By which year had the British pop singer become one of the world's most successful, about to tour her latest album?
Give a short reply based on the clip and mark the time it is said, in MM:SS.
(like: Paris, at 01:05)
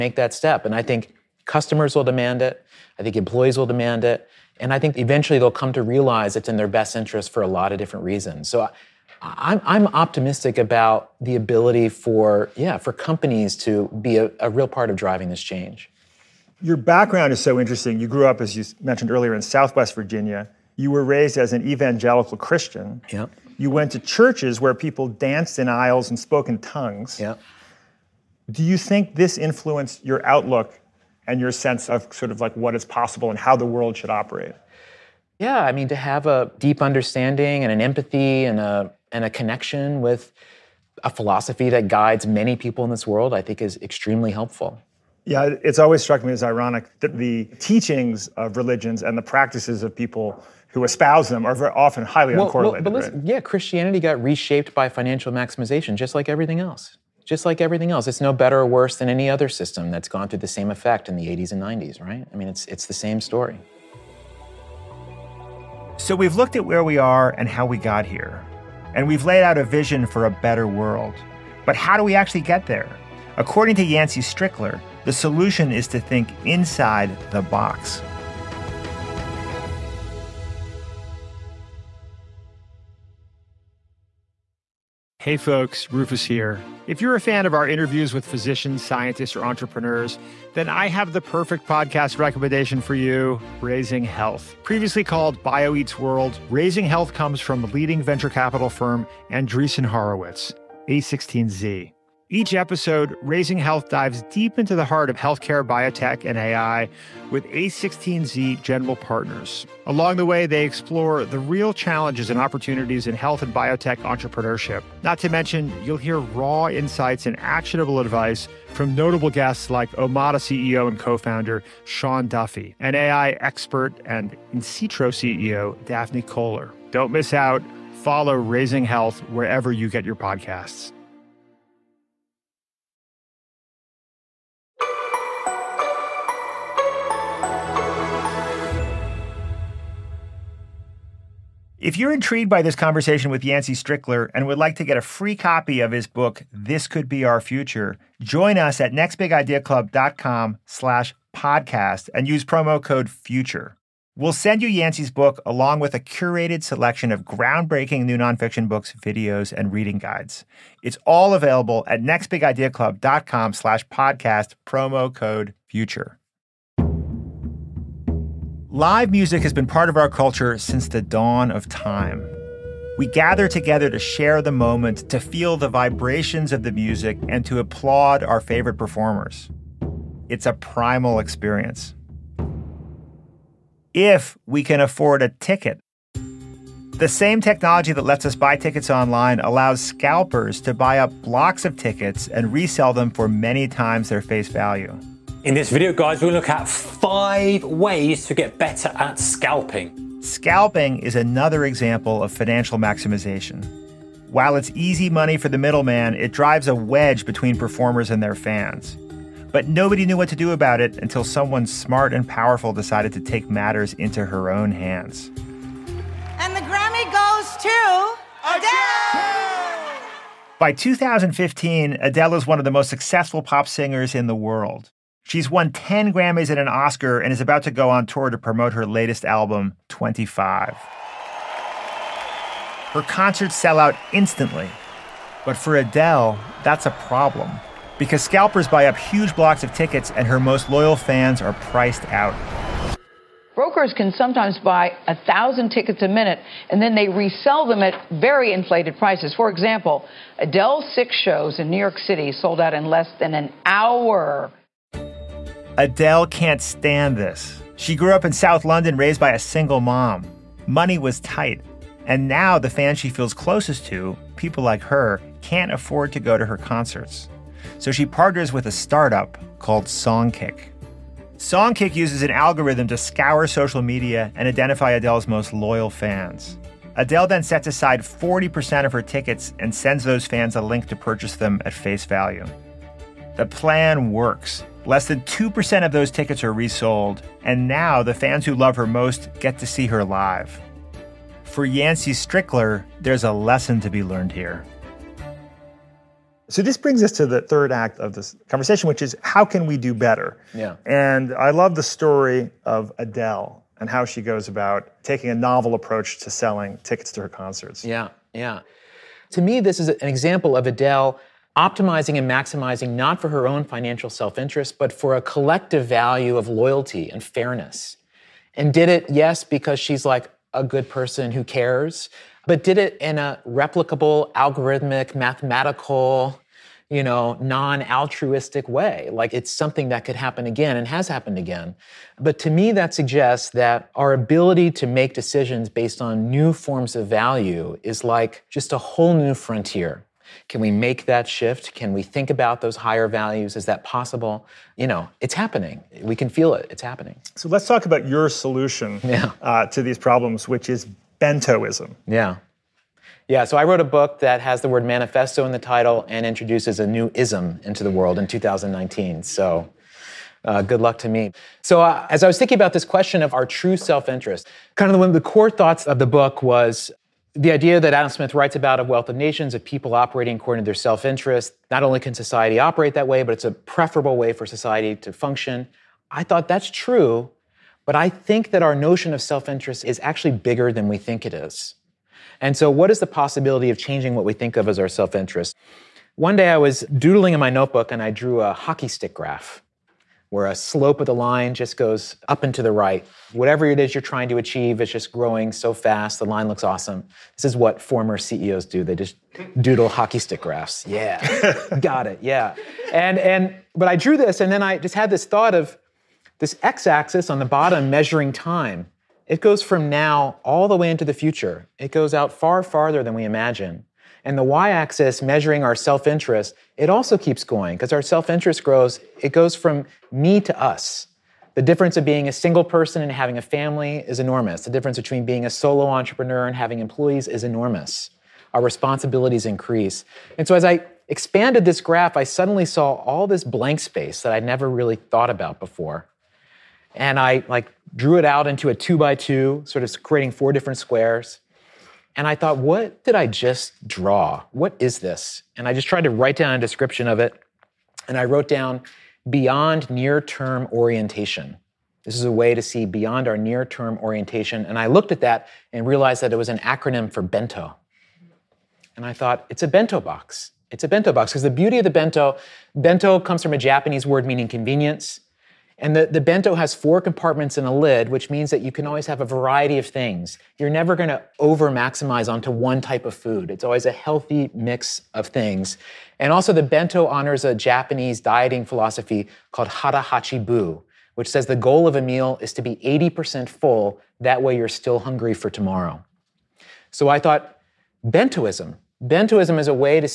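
2015, at 03:40.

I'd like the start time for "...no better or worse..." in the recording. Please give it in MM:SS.
00:58.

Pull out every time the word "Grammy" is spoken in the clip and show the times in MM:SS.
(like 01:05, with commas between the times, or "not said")
03:36, 03:46.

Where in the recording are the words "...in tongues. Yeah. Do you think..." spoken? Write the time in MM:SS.
00:26.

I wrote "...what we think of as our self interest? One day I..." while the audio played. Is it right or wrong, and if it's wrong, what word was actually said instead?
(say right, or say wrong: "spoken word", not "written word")
right.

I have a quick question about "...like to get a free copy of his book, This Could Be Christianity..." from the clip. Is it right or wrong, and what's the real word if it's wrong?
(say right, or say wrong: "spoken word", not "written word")
wrong: "Our", not "Christianity".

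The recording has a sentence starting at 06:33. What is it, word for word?
Whatever it is you're trying to achieve is just growing so fast, the line looks awesome.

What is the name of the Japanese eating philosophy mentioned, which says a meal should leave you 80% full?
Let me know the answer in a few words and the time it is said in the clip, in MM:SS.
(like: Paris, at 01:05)
hara bu, at 07:59.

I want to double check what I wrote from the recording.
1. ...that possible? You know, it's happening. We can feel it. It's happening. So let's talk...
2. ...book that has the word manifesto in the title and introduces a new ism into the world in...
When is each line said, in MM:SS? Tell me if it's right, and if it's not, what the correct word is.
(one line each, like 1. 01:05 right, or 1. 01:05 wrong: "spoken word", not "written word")
1. 05:43 right
2. 05:53 right.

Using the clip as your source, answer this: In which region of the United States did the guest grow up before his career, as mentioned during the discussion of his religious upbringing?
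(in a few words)
Southwest Virginia.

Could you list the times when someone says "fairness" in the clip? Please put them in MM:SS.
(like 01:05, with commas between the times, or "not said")
05:17.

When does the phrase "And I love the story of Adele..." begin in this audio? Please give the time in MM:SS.
05:00.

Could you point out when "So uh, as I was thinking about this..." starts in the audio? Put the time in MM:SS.
06:01.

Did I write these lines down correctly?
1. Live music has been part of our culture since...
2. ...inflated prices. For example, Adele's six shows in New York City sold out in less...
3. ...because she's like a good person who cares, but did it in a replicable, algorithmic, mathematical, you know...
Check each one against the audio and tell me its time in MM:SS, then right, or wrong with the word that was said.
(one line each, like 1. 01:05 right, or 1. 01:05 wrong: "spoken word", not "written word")
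1. 02:48 right
2. 04:08 right
3. 05:19 right.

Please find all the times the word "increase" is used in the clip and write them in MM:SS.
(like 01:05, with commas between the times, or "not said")
07:09.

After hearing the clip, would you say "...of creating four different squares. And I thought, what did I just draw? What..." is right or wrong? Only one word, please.
right.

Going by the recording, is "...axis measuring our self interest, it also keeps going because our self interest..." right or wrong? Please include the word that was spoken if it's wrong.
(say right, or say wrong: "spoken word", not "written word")
right.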